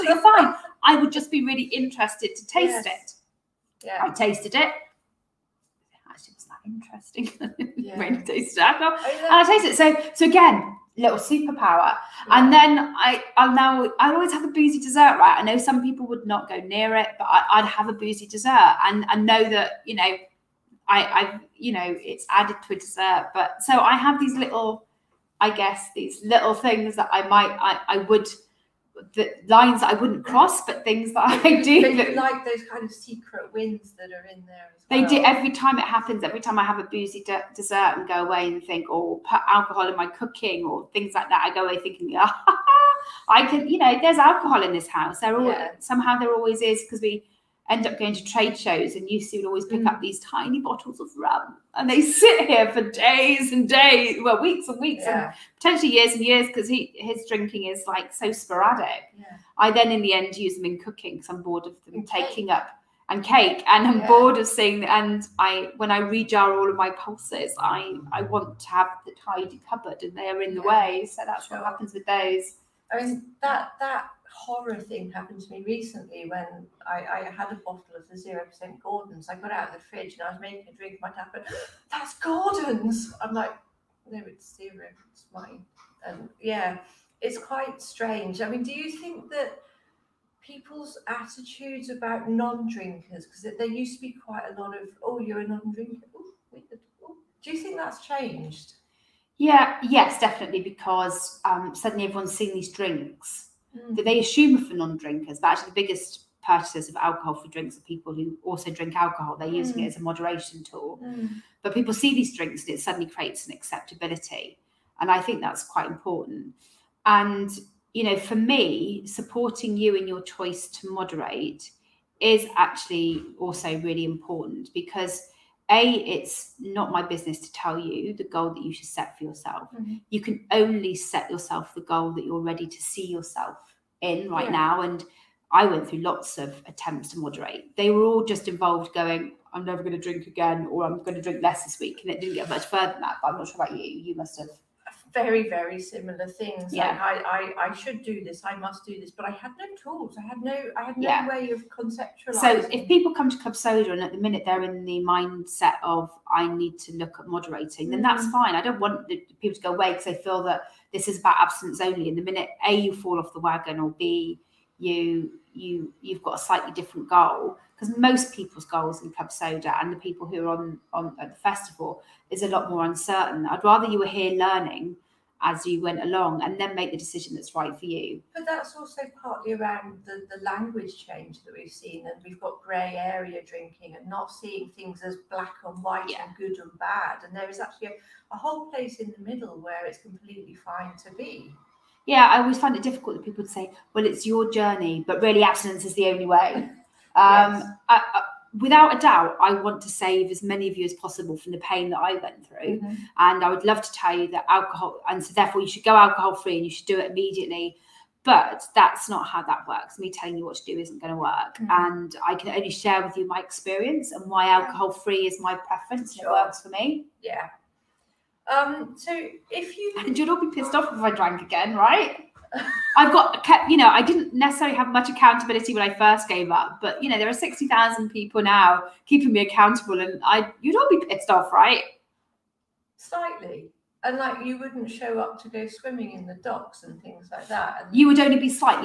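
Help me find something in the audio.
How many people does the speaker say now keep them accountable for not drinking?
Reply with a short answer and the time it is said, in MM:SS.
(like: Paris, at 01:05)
60,000, at 03:47.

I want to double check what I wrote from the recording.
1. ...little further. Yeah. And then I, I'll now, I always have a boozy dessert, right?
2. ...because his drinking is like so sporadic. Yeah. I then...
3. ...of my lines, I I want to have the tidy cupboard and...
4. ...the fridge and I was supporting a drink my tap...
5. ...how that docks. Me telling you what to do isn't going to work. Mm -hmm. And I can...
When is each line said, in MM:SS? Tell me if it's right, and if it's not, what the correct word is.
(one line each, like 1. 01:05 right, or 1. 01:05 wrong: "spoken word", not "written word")
1. 00:10 wrong: "superpower", not "further"
2. 00:56 right
3. 01:06 wrong: "pulses", not "lines"
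4. 01:19 wrong: "making", not "supporting"
5. 03:29 wrong: "works", not "docks".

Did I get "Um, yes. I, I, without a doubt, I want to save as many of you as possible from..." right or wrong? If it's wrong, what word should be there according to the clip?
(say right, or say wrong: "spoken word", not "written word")
right.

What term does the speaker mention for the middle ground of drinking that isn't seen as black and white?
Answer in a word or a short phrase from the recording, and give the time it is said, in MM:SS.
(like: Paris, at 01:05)
Grey area drinking, at 03:02.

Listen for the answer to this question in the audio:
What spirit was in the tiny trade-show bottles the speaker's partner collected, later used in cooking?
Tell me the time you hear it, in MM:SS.
00:51.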